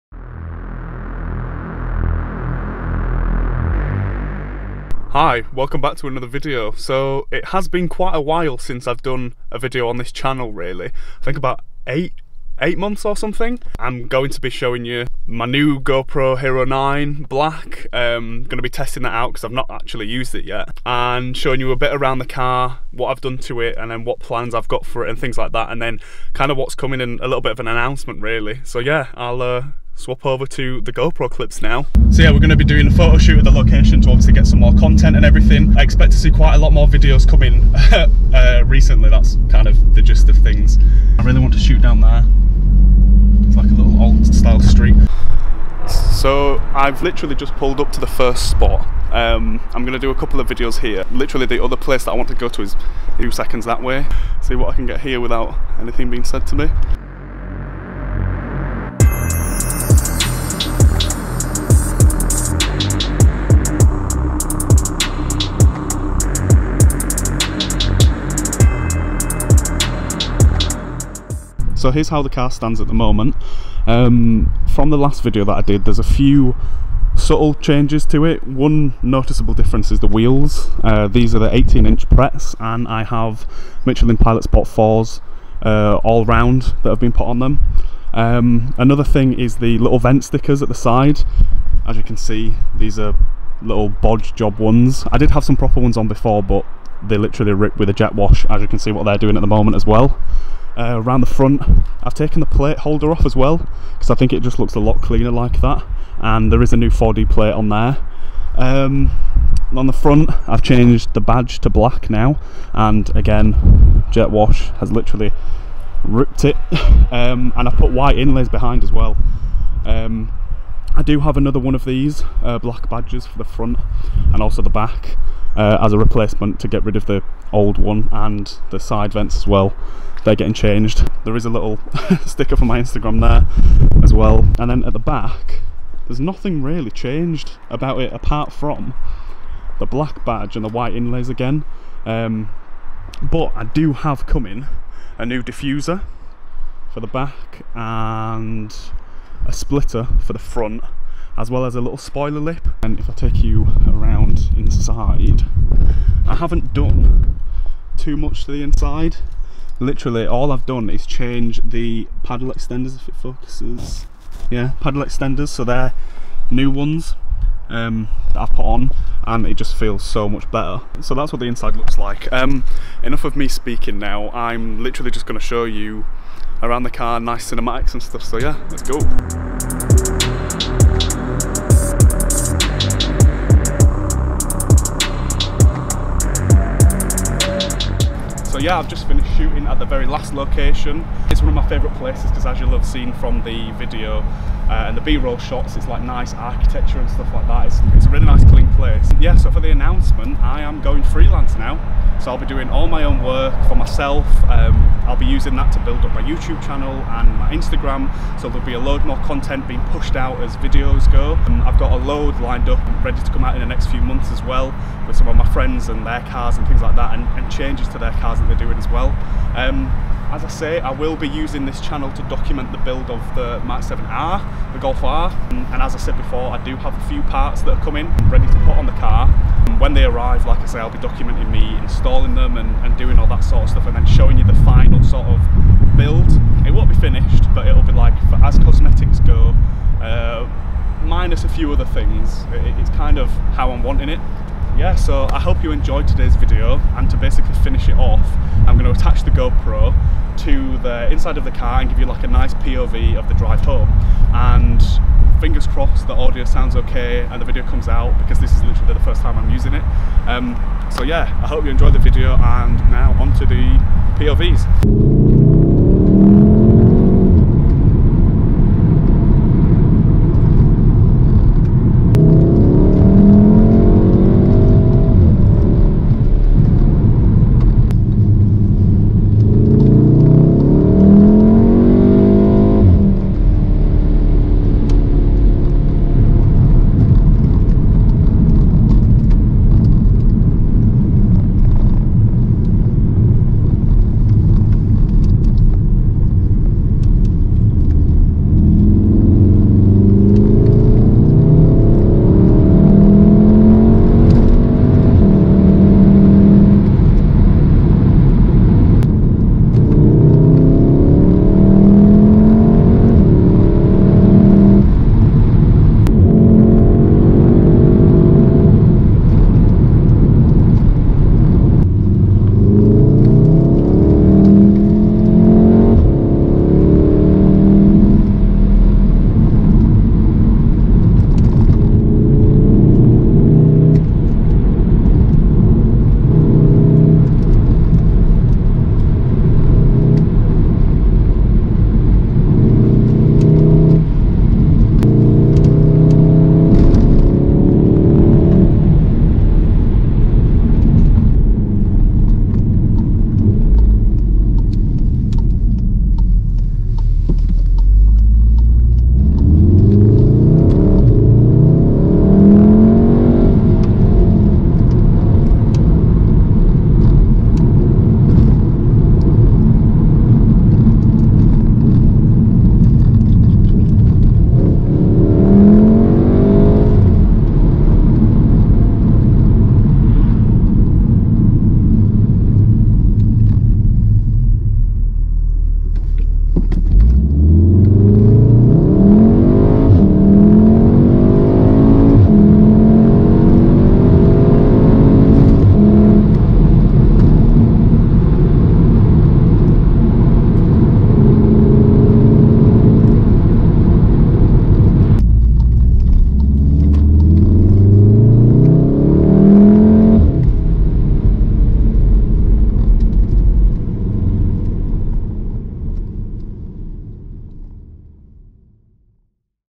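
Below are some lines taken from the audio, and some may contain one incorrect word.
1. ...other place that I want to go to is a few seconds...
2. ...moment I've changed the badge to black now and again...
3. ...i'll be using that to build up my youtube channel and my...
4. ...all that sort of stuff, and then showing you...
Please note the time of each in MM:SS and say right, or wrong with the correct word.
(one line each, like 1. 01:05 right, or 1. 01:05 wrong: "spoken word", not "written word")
1. 00:51 right
2. 01:49 wrong: "front", not "moment"
3. 03:25 right
4. 03:53 right.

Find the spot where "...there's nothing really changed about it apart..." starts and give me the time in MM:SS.
02:16.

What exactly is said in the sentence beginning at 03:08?
yeah, I've just finished shooting at the very last location.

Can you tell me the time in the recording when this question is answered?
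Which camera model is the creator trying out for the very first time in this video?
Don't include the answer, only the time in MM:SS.
00:15.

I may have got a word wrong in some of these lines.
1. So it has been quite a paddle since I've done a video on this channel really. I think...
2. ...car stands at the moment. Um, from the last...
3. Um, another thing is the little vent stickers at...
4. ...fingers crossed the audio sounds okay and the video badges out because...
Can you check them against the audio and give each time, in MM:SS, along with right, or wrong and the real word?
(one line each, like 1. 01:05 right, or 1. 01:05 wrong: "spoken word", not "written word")
1. 00:06 wrong: "while", not "paddle"
2. 01:12 right
3. 01:28 right
4. 04:15 wrong: "comes", not "badges".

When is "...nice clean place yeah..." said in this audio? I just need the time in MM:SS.
03:18.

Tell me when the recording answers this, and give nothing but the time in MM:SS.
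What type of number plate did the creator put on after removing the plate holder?
01:46.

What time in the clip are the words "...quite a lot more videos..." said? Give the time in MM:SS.
00:36.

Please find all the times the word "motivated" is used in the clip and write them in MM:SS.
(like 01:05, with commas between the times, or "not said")
not said.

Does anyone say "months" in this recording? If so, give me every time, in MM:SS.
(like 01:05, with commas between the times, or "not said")
00:12, 03:33.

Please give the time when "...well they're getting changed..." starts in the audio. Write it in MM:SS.
02:09.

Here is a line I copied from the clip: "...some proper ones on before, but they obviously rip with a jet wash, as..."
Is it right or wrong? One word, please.
wrong.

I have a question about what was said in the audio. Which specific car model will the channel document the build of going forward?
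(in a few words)
Golf R (Mark 7R).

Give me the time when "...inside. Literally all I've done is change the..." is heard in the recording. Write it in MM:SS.
02:38.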